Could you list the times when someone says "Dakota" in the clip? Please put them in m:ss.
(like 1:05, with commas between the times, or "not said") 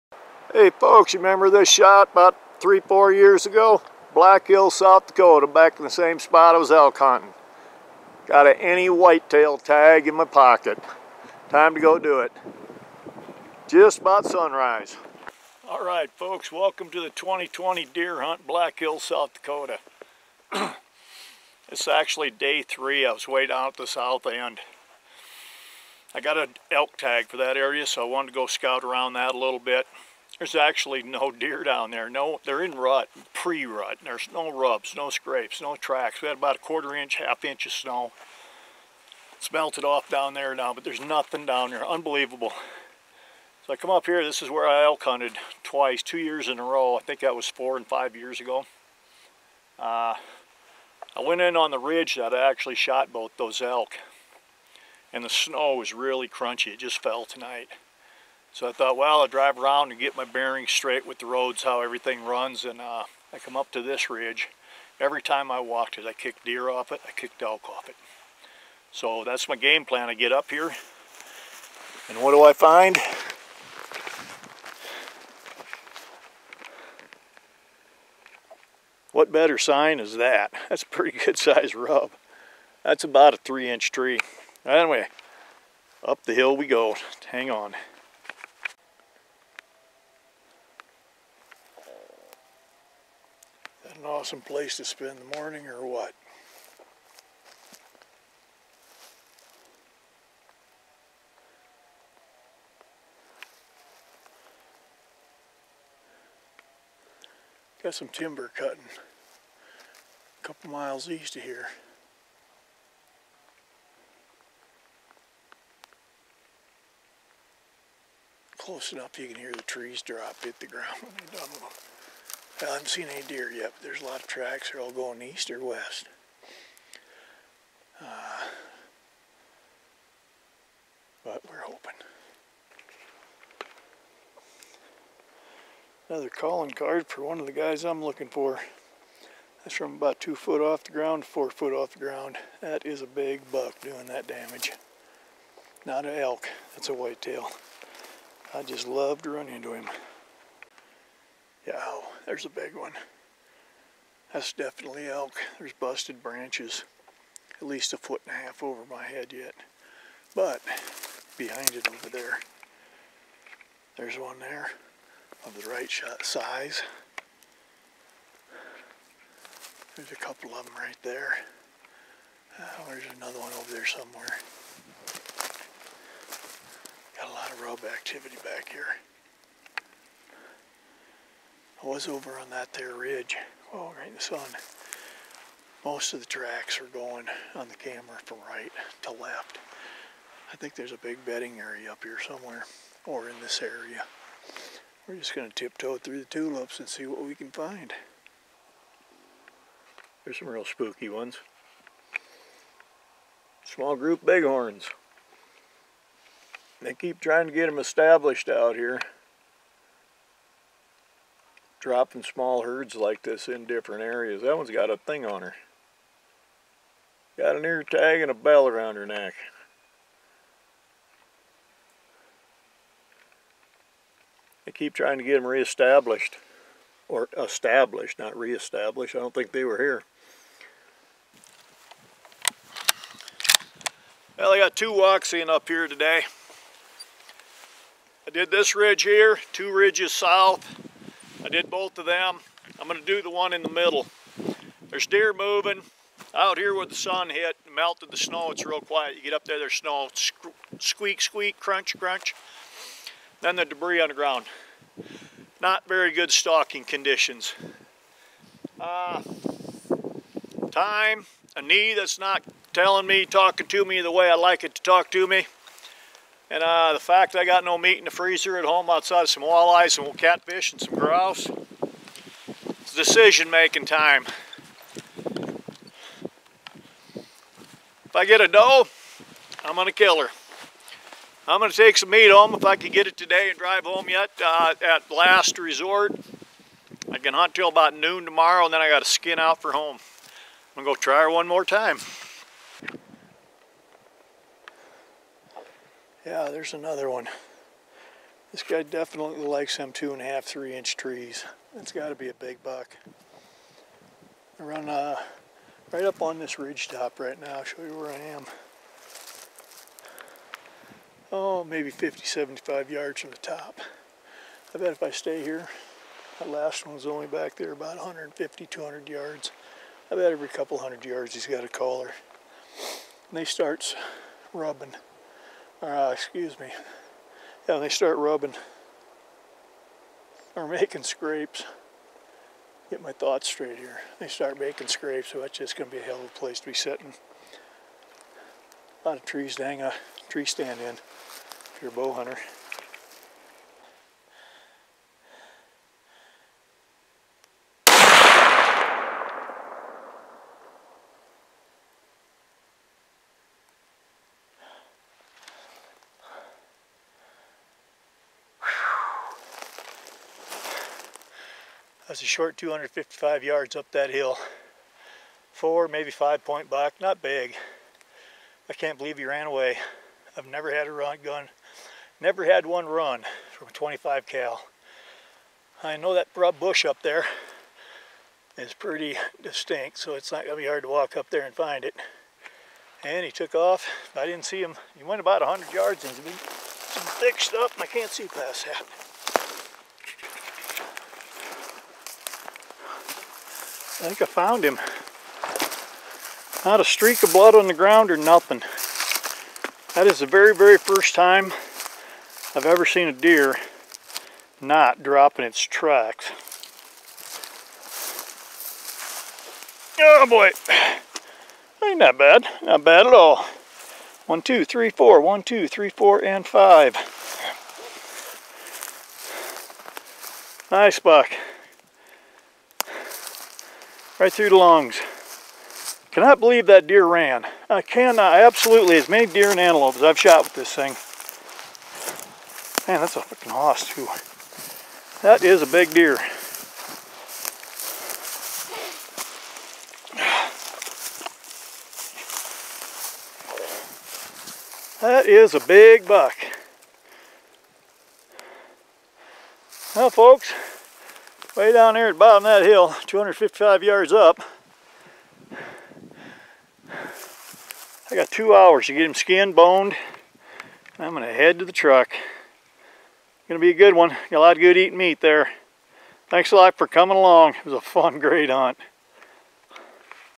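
0:05, 0:19.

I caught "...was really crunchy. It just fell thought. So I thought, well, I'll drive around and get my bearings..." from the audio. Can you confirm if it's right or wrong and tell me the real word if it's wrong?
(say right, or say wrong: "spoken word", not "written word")
wrong: "tonight", not "thought".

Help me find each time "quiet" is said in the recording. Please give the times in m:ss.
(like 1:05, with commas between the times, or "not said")
4:08.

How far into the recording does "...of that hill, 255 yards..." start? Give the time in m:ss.
7:32.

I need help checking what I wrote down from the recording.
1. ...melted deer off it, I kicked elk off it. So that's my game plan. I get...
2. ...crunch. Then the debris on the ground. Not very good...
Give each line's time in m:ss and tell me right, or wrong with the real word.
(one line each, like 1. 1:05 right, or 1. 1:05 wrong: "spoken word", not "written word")
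1. 1:06 wrong: "kicked", not "melted"
2. 4:11 right.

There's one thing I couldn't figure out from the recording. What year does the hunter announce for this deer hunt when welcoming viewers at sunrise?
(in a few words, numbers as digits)
2020.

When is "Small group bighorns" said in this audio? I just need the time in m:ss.
3:23.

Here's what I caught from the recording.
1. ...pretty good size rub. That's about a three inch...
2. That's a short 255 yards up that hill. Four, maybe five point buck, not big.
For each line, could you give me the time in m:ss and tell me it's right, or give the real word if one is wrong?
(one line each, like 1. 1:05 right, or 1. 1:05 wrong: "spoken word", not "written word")
1. 1:20 right
2. 6:02 right.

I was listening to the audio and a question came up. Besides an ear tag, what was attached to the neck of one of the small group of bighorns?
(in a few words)
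a bell.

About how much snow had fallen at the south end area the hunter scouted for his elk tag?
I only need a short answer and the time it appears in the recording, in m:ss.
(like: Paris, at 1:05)
quarter inch, half inch, at 0:36.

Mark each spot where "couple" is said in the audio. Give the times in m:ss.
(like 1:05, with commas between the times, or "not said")
1:50, 2:50, 5:20.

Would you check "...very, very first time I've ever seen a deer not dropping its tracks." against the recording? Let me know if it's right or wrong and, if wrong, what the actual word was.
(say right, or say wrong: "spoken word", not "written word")
right.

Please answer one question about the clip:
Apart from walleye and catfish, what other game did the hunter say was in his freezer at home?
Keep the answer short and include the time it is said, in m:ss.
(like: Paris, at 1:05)
grouse, at 4:30.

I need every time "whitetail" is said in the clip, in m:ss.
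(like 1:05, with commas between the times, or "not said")
0:08, 2:26.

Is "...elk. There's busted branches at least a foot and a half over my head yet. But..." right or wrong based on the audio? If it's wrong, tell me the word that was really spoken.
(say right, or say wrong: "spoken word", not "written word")
right.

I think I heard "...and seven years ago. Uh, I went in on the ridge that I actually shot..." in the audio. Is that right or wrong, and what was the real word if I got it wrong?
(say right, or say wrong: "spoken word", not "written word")
wrong: "five", not "seven".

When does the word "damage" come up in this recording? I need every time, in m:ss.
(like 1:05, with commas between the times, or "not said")
2:24.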